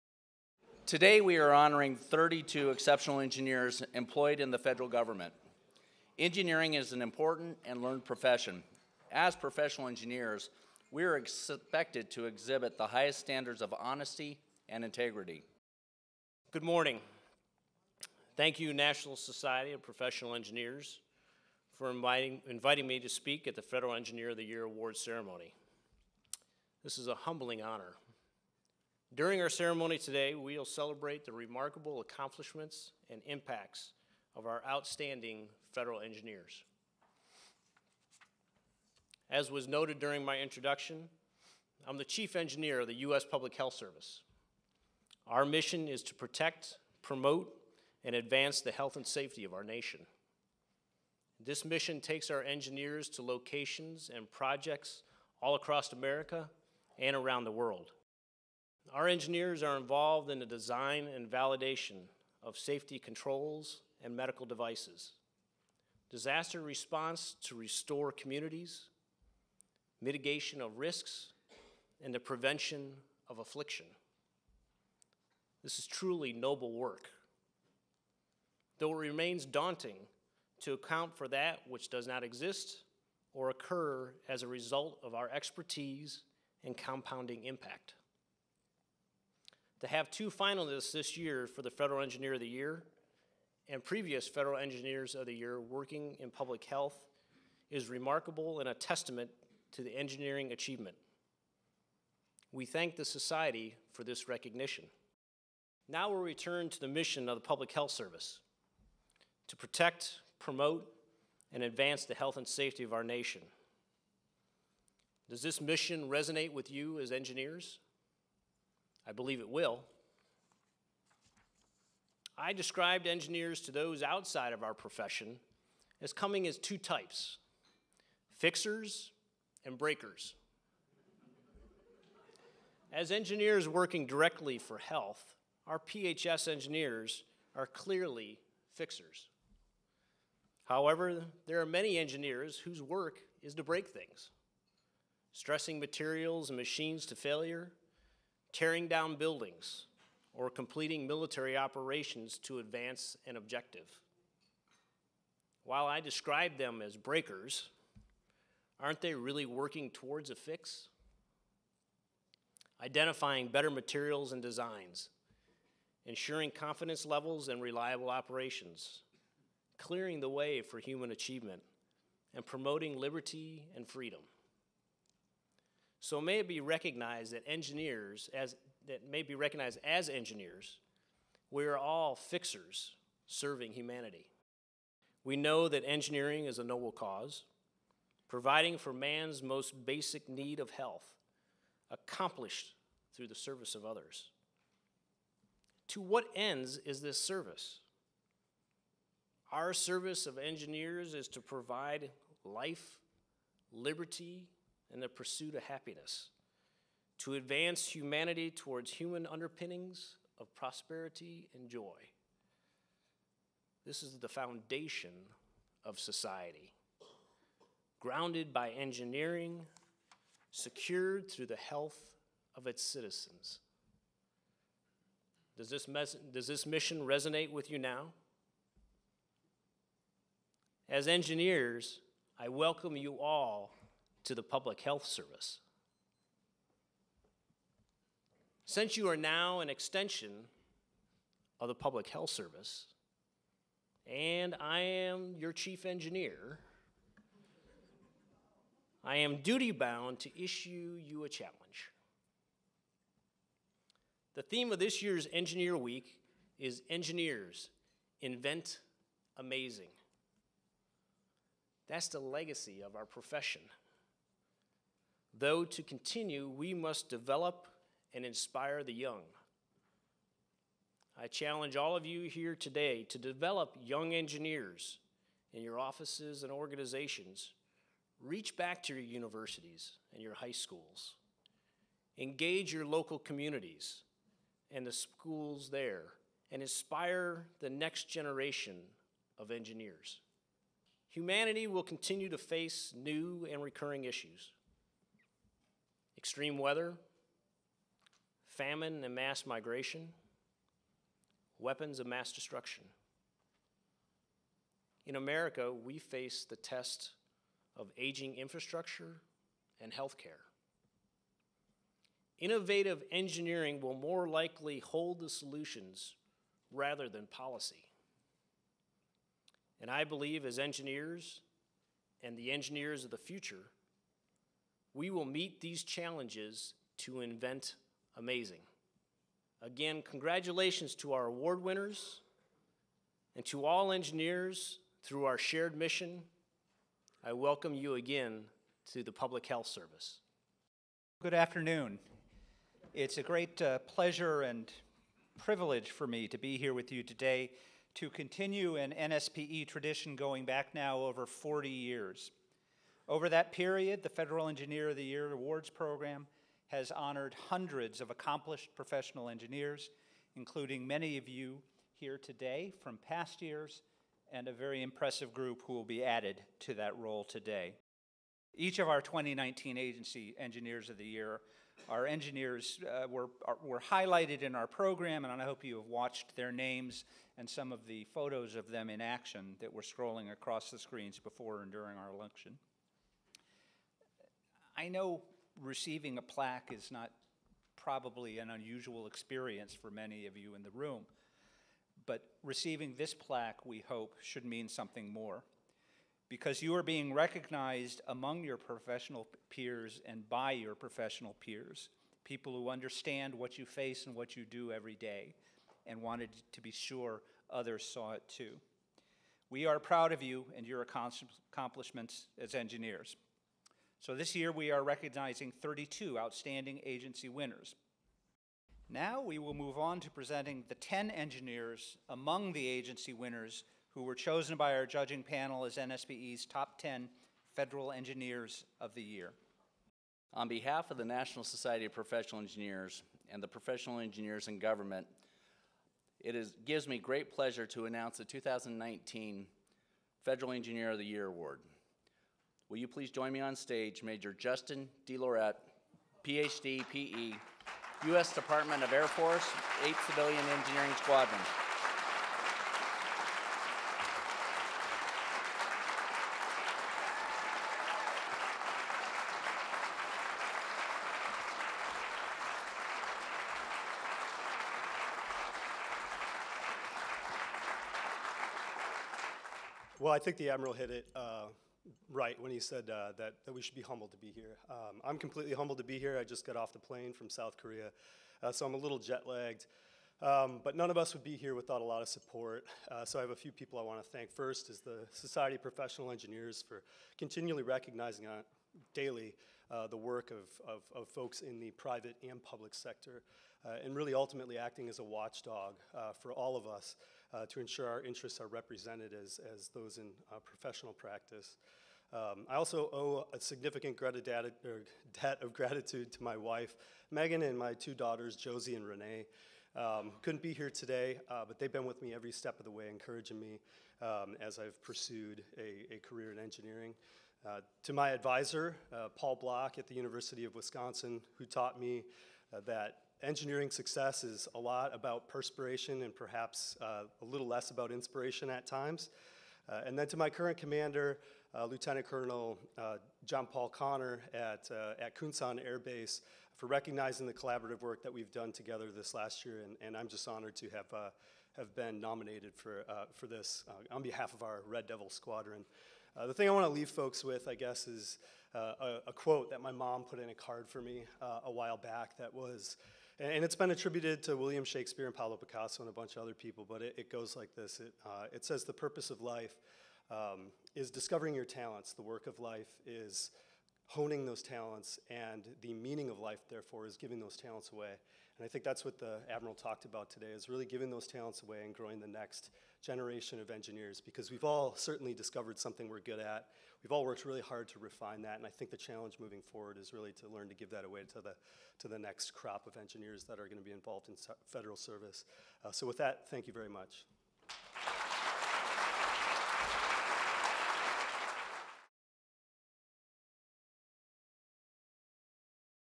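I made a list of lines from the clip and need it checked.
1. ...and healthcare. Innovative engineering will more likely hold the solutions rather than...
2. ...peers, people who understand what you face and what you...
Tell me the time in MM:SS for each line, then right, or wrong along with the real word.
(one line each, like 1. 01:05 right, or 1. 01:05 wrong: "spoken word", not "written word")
1. 05:09 right
2. 06:41 right.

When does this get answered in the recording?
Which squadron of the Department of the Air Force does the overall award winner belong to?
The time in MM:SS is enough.
07:29.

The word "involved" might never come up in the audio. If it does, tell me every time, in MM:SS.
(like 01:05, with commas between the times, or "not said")
00:59, 09:43.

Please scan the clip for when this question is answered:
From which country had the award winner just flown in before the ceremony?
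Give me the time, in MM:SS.
07:57.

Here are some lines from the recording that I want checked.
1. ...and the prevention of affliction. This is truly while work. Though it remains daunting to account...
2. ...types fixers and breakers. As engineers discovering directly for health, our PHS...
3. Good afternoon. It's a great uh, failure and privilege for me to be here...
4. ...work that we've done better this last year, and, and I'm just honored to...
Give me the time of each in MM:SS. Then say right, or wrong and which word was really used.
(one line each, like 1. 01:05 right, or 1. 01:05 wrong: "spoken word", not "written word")
1. 01:12 wrong: "noble", not "while"
2. 02:06 wrong: "working", not "discovering"
3. 05:41 wrong: "pleasure", not "failure"
4. 08:57 wrong: "together", not "better".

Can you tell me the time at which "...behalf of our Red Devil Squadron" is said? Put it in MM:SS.
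09:04.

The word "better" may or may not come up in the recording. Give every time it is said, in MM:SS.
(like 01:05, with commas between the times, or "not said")
02:43.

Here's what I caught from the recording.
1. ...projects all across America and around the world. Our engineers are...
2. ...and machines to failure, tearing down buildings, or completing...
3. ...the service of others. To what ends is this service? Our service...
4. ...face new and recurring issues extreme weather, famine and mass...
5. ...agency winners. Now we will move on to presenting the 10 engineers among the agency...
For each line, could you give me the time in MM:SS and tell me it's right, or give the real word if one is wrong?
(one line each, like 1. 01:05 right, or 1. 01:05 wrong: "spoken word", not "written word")
1. 00:54 right
2. 02:26 right
3. 03:13 right
4. 04:52 right
5. 06:56 right.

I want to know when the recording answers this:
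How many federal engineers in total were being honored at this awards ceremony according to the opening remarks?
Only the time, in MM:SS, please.
00:01.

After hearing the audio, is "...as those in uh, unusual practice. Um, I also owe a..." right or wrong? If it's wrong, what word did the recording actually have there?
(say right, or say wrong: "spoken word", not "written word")
wrong: "professional", not "unusual".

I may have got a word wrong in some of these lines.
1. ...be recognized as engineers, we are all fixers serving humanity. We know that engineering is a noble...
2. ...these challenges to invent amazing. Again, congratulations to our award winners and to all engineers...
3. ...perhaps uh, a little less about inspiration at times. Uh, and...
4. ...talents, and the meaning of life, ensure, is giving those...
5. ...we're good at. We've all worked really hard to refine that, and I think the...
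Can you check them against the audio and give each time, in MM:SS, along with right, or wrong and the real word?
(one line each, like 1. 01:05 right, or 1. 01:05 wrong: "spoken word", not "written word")
1. 02:59 right
2. 05:25 right
3. 08:46 right
4. 09:24 wrong: "therefore", not "ensure"
5. 09:35 right.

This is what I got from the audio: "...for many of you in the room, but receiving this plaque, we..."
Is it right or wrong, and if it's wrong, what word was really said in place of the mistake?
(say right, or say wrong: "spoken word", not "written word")
right.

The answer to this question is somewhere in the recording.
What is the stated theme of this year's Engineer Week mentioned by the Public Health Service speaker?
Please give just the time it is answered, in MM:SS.
04:16.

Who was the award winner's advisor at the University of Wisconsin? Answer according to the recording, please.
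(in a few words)
Paul Block.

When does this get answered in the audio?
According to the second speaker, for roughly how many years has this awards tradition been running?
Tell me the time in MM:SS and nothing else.
05:50.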